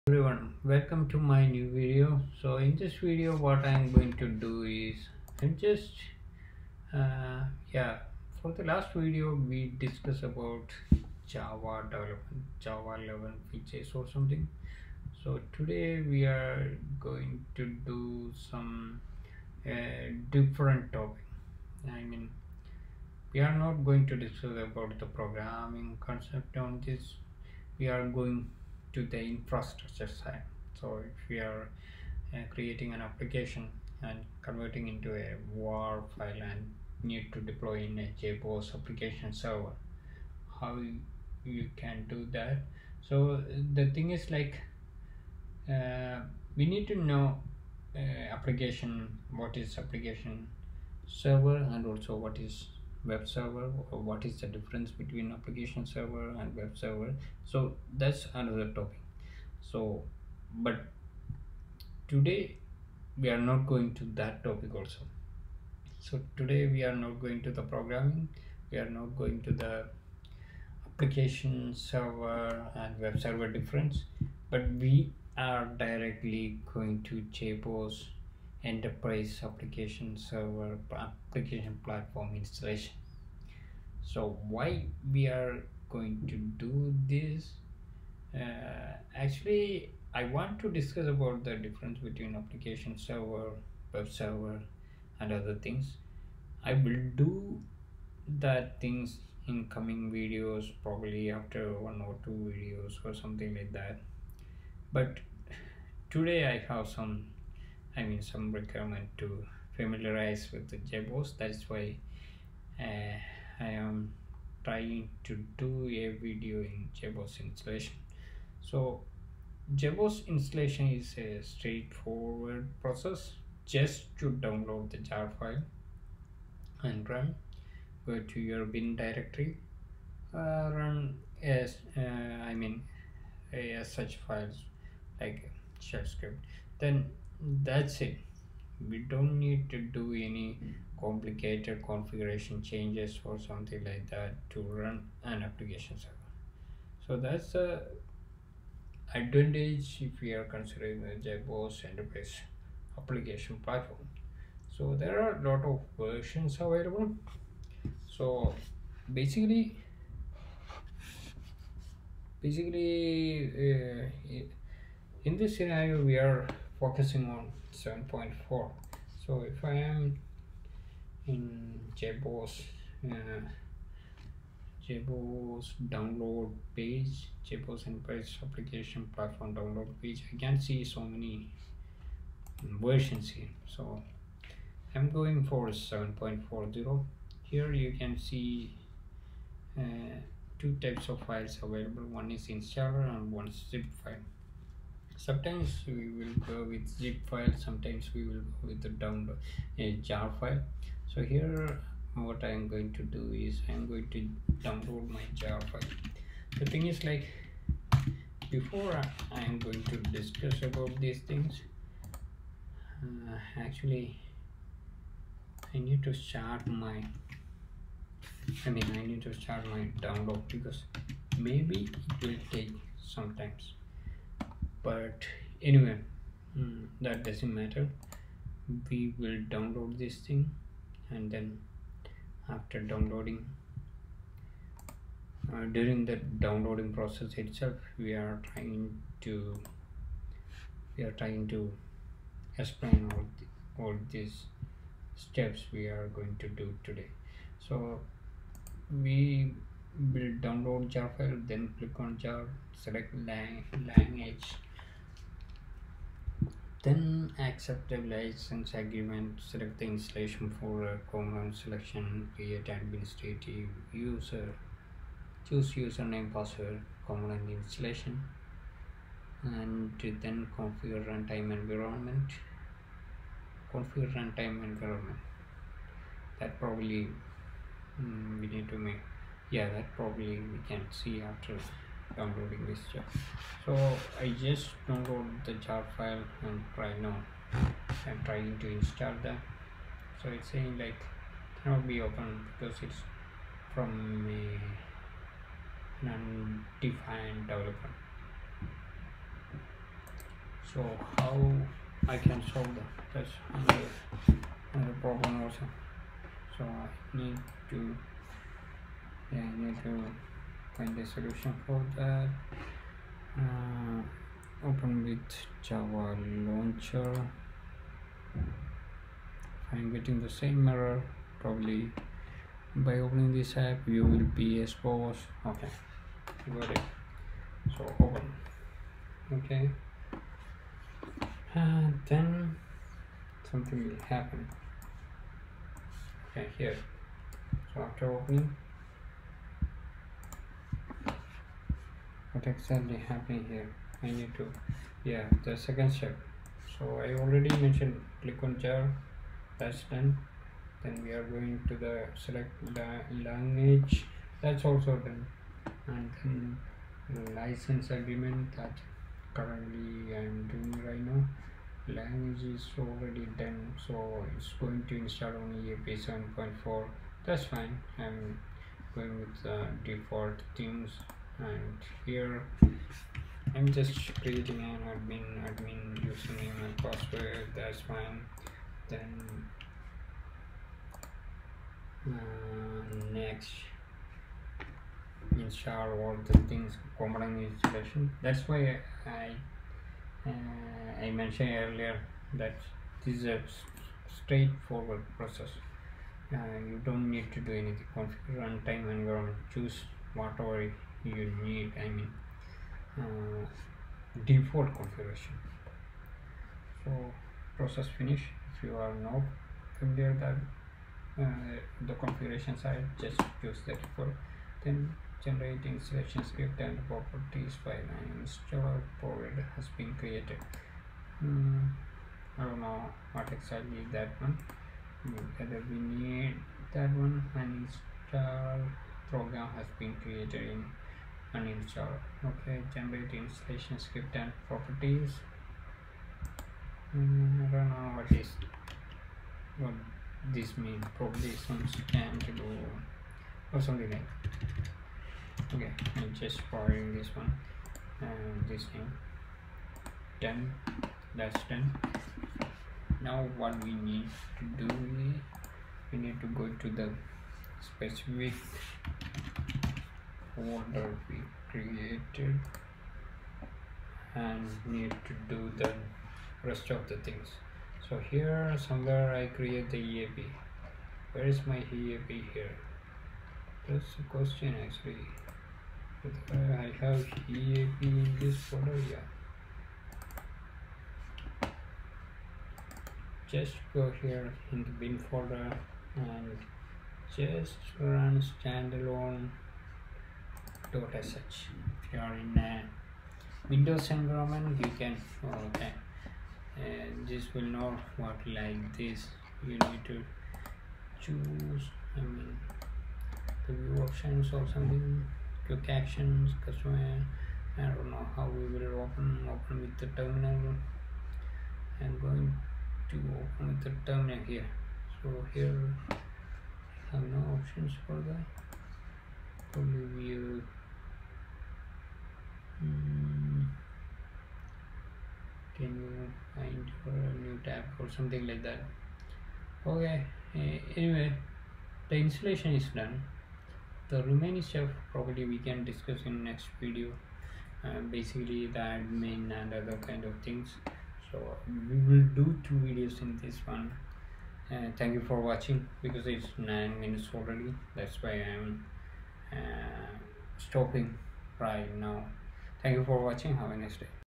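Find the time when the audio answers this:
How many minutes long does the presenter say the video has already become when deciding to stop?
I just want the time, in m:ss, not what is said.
9:06.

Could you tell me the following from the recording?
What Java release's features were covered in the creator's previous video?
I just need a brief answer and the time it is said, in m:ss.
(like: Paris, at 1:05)
Java 11, at 0:12.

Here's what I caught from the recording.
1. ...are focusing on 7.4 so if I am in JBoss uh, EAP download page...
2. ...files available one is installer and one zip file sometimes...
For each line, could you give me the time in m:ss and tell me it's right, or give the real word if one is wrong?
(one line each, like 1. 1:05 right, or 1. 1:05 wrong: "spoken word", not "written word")
1. 2:46 wrong: "JBoss", not "EAP"
2. 3:11 right.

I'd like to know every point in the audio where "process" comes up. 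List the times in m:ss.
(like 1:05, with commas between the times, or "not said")
2:02, 3:56, 6:35, 6:47.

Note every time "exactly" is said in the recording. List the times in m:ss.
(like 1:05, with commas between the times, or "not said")
5:42, 7:03.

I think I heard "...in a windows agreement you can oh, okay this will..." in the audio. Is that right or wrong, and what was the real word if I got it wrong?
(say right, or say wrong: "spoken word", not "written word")
wrong: "environment", not "agreement".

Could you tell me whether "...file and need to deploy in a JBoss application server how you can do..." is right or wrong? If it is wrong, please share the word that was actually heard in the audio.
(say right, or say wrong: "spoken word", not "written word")
right.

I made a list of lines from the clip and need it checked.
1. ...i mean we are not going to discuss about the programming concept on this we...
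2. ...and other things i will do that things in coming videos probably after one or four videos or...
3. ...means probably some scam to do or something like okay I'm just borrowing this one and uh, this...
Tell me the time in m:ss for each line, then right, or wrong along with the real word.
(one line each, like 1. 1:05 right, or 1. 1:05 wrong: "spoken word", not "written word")
1. 0:21 right
2. 1:35 wrong: "two", not "four"
3. 7:20 right.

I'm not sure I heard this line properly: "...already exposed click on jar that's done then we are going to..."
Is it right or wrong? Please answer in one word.
wrong.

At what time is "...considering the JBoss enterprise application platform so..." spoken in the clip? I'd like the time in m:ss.
2:30.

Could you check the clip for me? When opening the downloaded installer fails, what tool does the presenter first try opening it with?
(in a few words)
java launcher.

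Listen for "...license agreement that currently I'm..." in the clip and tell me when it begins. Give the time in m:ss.
5:57.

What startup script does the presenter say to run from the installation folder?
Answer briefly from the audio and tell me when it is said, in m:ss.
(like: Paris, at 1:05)
standalone, at 8:08.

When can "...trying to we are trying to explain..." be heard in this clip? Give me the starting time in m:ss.
3:58.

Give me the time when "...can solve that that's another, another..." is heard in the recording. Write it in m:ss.
5:02.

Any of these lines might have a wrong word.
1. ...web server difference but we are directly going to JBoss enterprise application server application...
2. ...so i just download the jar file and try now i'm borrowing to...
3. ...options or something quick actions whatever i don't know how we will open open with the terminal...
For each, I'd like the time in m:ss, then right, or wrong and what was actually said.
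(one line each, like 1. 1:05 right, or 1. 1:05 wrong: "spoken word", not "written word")
1. 1:13 right
2. 4:43 wrong: "trying", not "borrowing"
3. 8:23 wrong: "customer", not "whatever".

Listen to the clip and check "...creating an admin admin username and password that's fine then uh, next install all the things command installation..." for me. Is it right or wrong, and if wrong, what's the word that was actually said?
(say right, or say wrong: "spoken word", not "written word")
right.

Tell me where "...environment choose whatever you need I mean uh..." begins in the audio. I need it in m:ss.
6:38.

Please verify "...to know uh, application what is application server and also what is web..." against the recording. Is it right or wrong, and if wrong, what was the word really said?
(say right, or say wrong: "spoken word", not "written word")
right.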